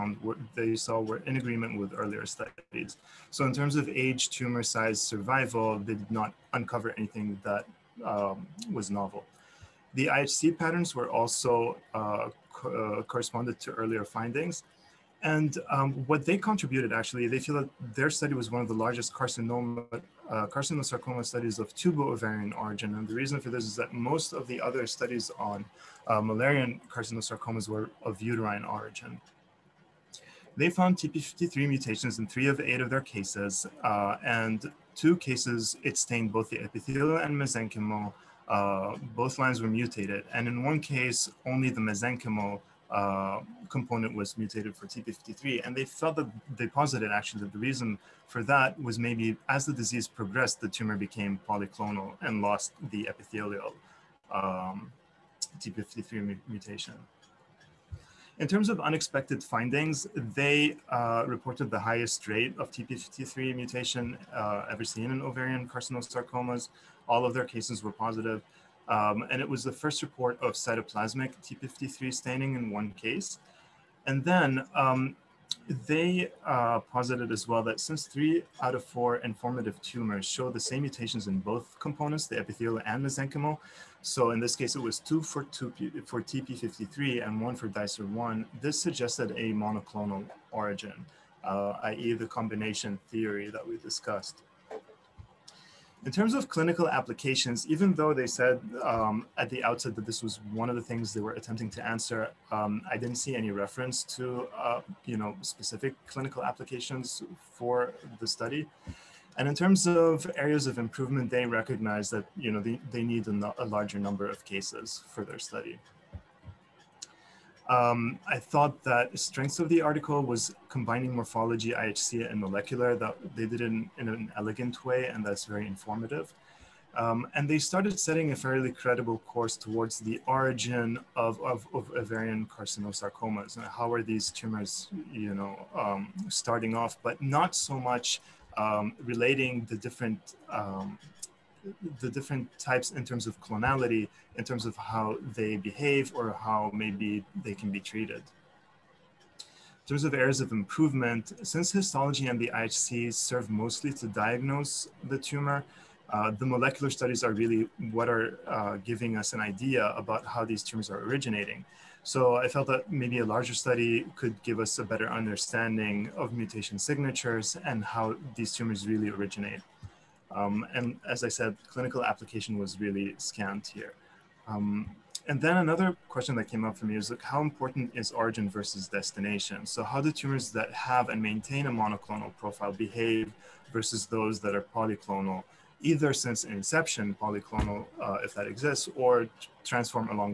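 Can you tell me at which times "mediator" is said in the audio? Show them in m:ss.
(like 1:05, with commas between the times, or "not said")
not said.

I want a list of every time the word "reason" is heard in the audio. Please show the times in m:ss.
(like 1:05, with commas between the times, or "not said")
0:23, 0:47.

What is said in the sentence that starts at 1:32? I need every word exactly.
the combination theory that we discussed.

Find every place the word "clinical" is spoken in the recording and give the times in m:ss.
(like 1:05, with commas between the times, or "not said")
1:36, 1:46, 2:51.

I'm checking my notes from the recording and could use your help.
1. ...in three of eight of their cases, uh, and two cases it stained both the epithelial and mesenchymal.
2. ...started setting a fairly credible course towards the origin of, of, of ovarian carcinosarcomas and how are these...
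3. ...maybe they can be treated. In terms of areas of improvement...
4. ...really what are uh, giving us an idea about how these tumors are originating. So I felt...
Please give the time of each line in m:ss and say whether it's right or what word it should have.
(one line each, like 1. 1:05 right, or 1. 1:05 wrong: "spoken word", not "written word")
1. 0:32 right
2. 2:07 right
3. 2:26 right
4. 2:37 right.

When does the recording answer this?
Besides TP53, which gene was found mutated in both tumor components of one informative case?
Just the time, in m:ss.
1:27.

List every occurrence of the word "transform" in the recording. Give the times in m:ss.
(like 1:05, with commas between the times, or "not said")
3:09.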